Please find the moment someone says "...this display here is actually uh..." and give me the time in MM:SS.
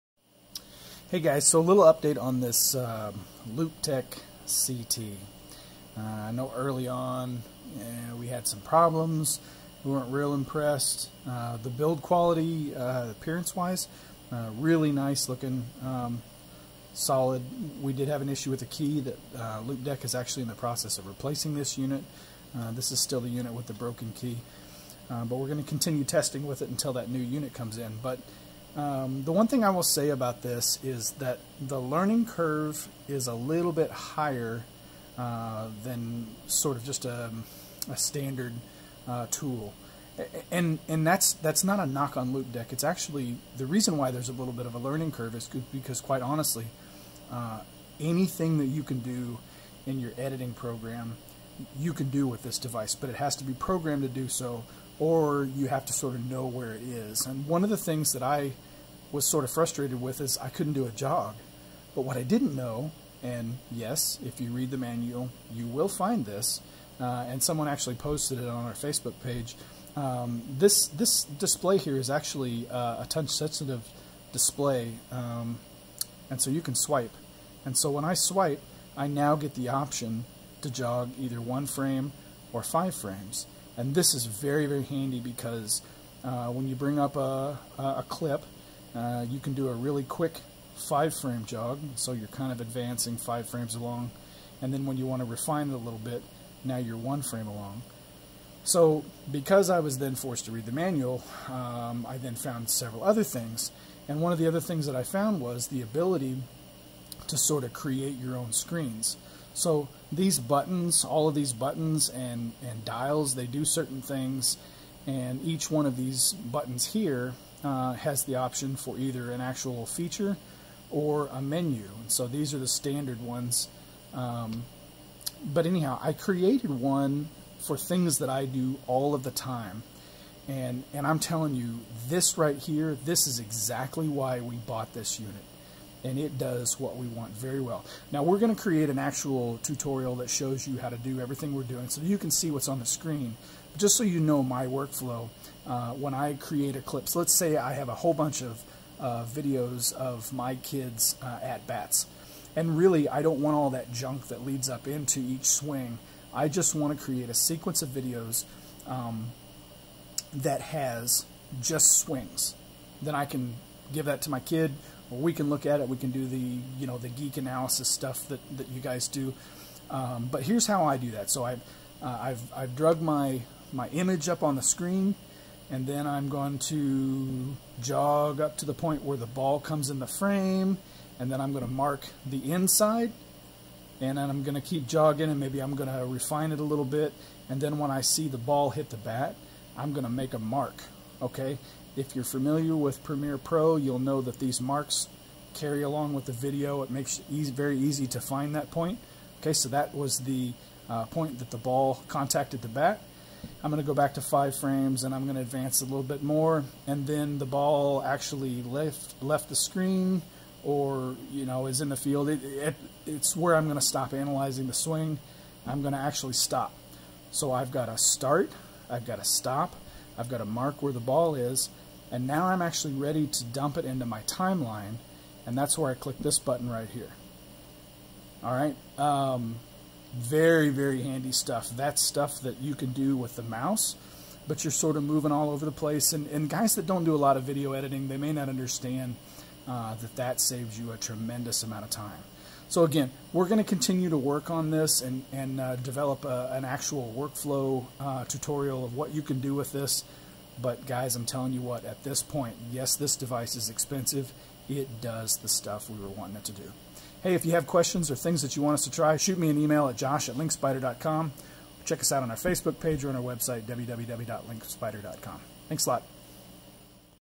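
01:10.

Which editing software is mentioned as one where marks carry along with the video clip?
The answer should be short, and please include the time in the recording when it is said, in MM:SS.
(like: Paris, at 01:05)
Premiere Pro, at 03:13.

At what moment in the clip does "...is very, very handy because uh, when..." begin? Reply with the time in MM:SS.
01:24.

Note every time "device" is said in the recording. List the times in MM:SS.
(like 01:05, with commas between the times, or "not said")
00:52, 04:13.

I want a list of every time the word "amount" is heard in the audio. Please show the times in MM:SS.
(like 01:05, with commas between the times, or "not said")
04:01.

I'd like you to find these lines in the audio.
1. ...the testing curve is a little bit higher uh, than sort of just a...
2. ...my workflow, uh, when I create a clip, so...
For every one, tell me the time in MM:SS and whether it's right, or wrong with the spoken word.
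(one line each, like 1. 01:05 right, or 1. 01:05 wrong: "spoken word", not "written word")
1. 00:31 wrong: "learning", not "testing"
2. 02:24 right.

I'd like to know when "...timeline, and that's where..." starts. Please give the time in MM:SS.
03:44.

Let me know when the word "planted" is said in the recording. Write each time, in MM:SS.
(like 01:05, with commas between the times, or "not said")
not said.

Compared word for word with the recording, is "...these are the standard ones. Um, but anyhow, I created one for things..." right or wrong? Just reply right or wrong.
right.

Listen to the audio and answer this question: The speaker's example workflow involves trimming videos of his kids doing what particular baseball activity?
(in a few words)
At bats.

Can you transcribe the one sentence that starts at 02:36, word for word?
I just want to create a sequence of videos um, that has just swings.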